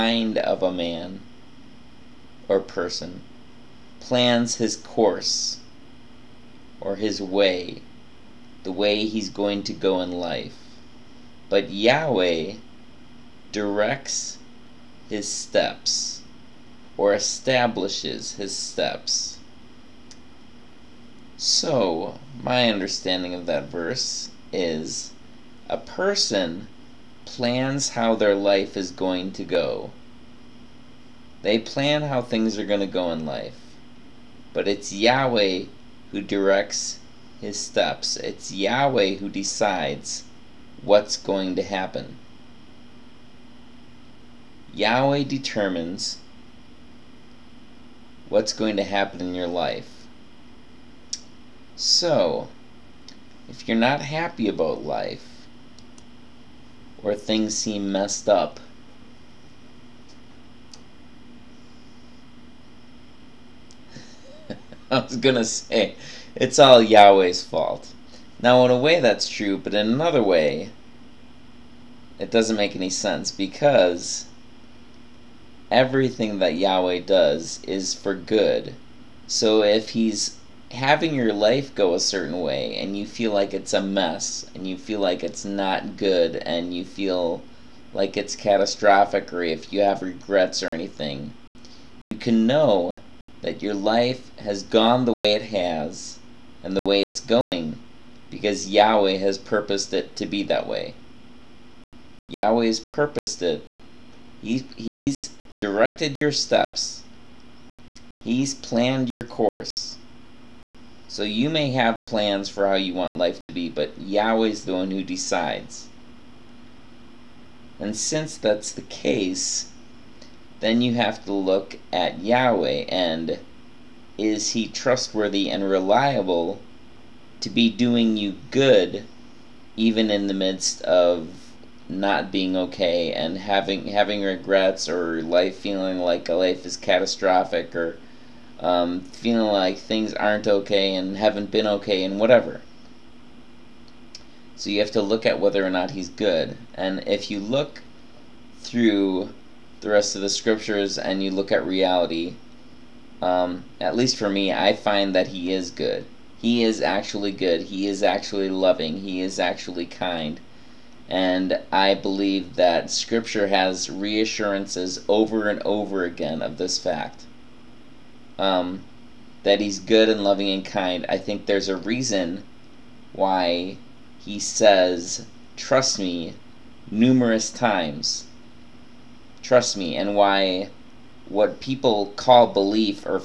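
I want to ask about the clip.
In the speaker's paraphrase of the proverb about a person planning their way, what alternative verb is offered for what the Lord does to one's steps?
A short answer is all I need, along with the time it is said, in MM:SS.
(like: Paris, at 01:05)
establishes, at 00:17.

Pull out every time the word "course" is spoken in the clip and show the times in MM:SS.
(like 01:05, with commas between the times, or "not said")
00:04, 01:49.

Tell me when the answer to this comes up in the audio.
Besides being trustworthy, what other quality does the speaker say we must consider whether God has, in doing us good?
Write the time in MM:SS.
02:05.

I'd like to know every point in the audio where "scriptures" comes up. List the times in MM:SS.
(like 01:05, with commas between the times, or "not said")
02:30, 02:42.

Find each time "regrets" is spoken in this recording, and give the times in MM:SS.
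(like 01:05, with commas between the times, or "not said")
01:30, 02:14.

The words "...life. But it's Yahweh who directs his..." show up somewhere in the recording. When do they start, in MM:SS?
00:33.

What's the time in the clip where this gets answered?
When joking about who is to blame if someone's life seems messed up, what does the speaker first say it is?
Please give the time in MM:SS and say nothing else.
01:06.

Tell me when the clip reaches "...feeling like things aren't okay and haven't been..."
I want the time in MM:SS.
02:19.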